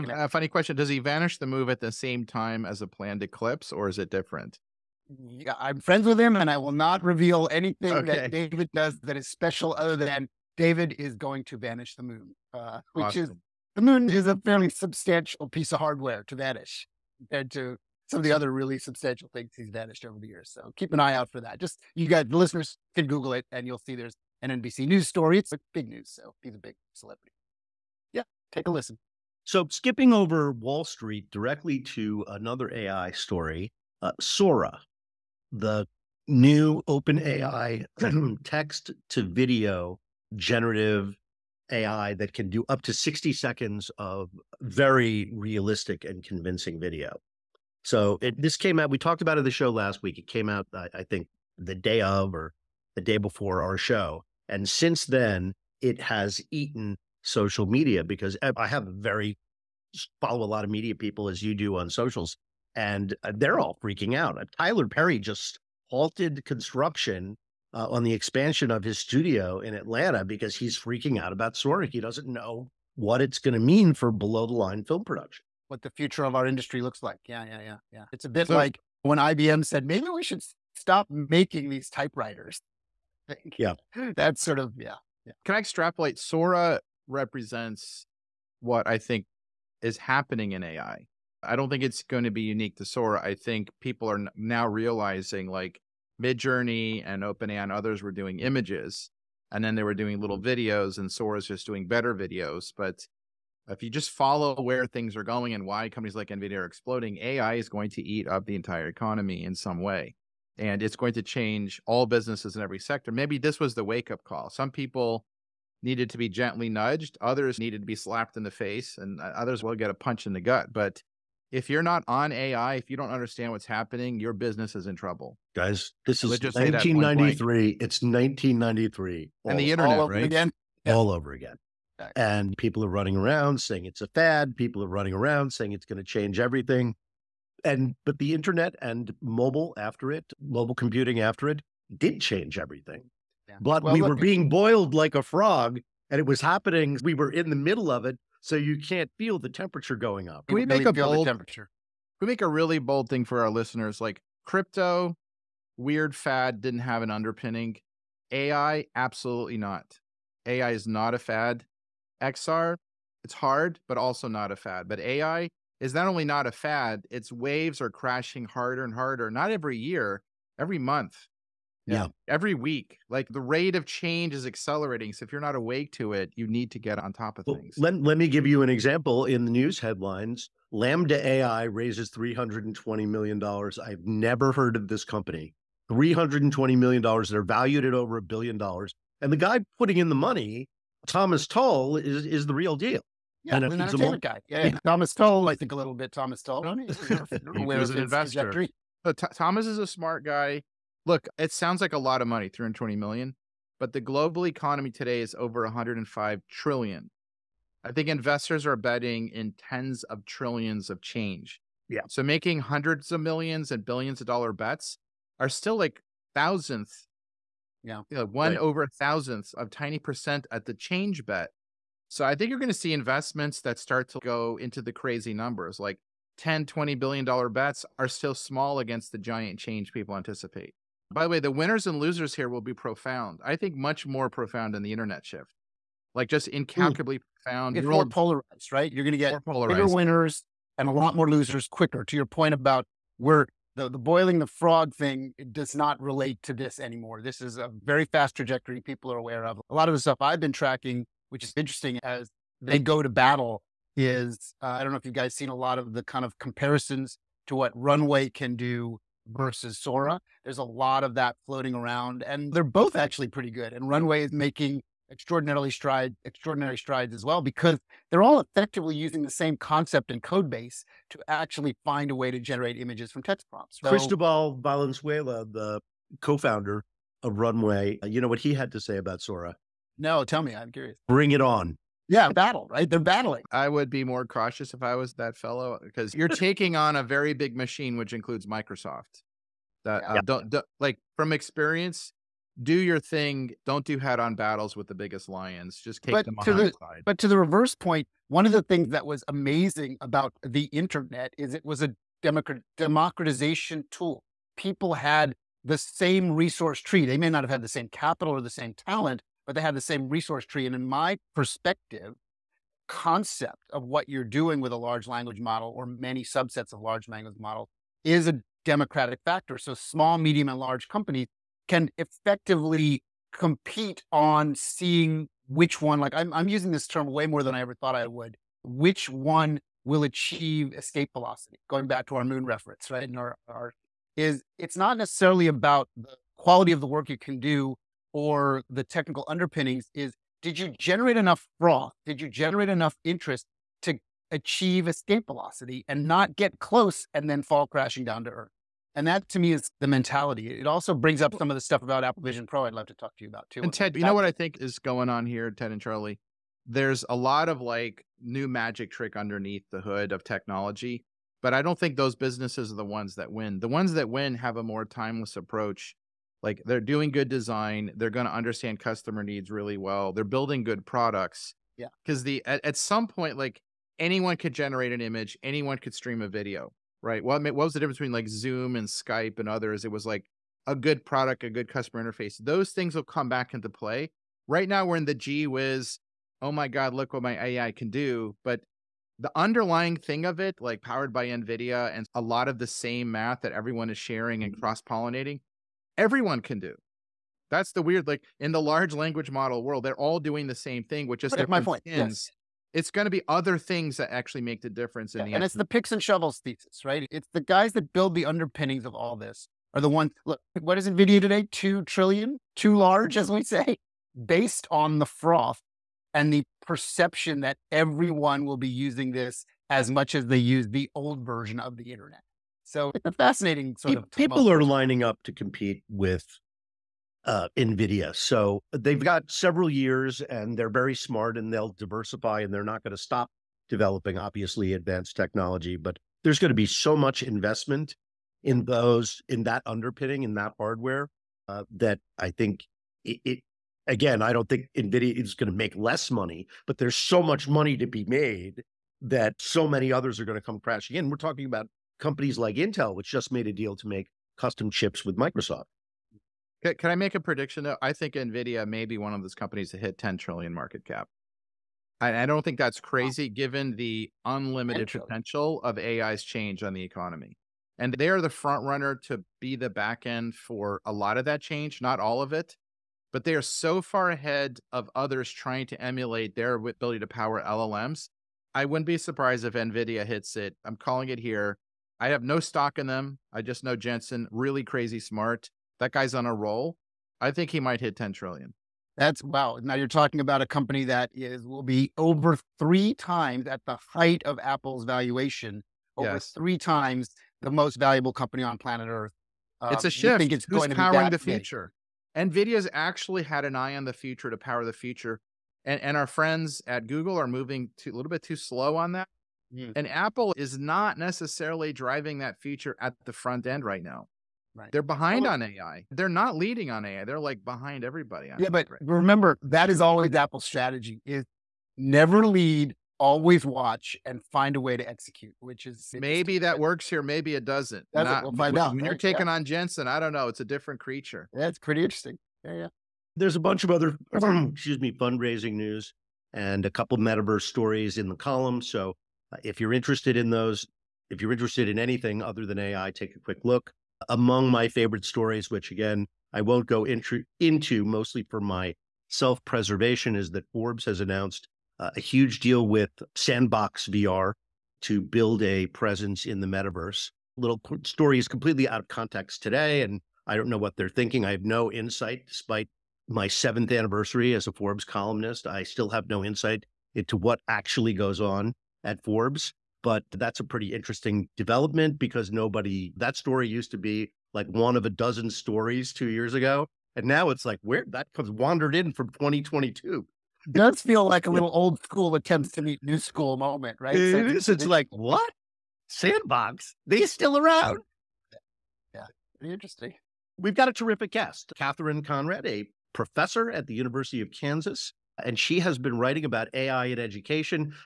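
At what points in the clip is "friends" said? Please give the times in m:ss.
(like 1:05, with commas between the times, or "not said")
0:05, 8:26.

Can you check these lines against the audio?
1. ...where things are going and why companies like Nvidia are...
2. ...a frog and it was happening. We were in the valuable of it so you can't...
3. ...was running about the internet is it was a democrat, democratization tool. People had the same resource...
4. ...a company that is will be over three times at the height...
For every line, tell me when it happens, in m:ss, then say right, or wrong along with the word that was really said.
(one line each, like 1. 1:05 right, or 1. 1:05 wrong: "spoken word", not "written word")
1. 1:44 right
2. 2:25 wrong: "middle", not "valuable"
3. 4:59 wrong: "amazing", not "running"
4. 8:10 right.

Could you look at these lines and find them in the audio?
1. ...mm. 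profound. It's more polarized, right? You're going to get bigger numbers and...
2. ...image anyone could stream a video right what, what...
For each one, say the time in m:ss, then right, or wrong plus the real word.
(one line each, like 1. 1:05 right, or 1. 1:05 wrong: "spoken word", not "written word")
1. 3:57 wrong: "winners", not "numbers"
2. 6:14 right.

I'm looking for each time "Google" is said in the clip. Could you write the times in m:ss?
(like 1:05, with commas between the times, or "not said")
0:23, 8:26.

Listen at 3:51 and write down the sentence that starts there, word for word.
By the way, the winners and losers here will be profound.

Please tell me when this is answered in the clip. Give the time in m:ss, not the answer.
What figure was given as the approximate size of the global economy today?
3:25.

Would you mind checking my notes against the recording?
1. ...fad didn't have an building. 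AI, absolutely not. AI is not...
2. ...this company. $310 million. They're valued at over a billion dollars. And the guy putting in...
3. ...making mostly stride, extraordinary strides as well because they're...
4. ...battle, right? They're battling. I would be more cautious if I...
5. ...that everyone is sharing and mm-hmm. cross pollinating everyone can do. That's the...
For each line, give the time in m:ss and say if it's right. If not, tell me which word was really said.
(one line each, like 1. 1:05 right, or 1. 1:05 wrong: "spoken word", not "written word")
1. 2:36 wrong: "underpinning", not "building"
2. 3:04 wrong: "320", not "310"
3. 4:24 wrong: "extraordinarily", not "mostly"
4. 4:42 right
5. 6:33 right.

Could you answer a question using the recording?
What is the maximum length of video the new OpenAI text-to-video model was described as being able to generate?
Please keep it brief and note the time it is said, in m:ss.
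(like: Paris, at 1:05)
60 seconds, at 0:42.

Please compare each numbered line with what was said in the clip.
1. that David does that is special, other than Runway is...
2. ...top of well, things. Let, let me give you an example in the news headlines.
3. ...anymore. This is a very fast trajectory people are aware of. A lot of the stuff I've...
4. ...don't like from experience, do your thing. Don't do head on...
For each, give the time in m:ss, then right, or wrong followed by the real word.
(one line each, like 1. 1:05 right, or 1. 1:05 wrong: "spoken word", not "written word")
1. 0:08 wrong: "David", not "Runway"
2. 2:57 right
3. 4:06 right
4. 4:50 right.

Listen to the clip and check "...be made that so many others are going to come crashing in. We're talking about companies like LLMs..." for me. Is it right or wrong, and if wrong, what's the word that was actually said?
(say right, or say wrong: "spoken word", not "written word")
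wrong: "Intel", not "LLMs".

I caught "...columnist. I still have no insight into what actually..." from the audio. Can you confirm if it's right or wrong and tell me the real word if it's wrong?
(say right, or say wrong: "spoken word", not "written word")
right.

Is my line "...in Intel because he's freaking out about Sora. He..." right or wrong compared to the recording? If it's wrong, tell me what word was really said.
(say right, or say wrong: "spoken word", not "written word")
wrong: "Atlanta", not "Intel".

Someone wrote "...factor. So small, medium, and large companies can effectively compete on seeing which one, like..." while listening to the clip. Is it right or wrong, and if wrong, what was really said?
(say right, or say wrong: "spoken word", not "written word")
right.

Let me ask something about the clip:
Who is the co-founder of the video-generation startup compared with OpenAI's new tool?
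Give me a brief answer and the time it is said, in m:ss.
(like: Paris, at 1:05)
Cristobal Valenzuela, at 4:33.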